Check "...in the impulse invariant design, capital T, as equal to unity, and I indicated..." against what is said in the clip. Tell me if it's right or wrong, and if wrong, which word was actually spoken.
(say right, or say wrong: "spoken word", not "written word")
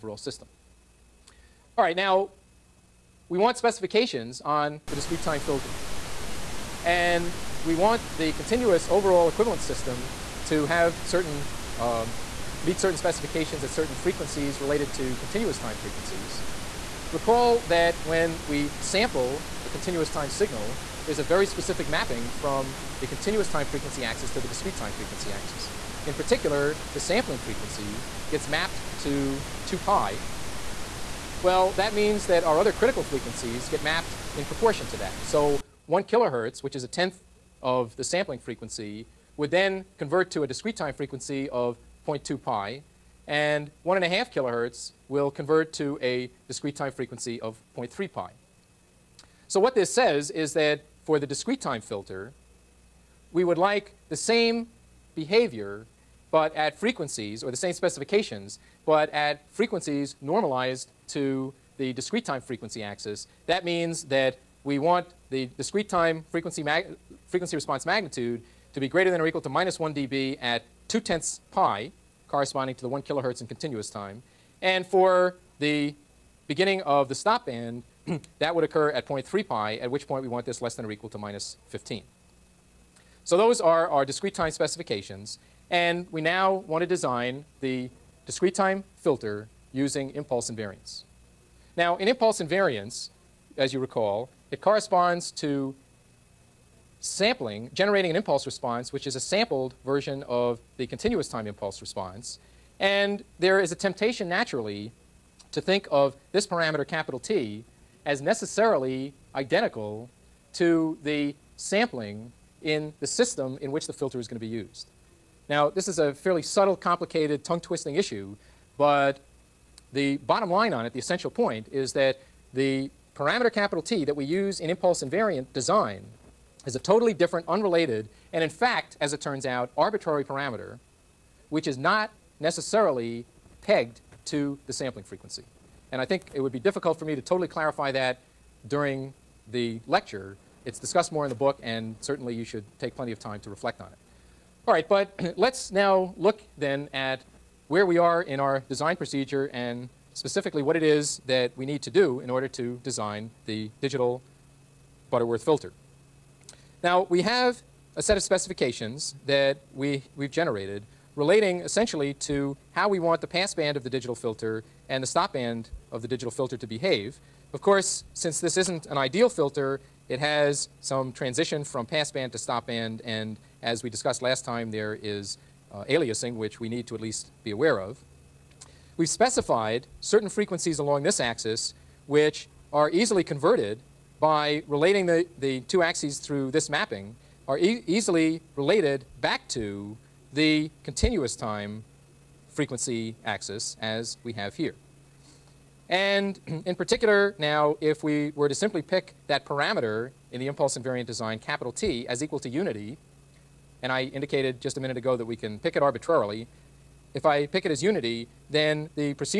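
right.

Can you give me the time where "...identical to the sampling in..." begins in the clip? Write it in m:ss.
1:49.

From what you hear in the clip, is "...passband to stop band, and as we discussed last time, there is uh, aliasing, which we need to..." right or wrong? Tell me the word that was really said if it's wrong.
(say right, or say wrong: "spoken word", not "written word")
right.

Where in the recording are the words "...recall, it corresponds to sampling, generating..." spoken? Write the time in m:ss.
1:33.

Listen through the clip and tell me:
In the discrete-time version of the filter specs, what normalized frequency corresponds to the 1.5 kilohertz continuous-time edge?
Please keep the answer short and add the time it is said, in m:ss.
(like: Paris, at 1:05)
0.3 pi, at 0:47.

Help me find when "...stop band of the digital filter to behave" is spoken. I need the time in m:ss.
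2:45.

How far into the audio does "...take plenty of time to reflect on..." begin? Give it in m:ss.
2:22.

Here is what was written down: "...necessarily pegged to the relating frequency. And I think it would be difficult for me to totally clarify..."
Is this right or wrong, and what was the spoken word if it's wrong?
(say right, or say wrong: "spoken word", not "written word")
wrong: "sampling", not "relating".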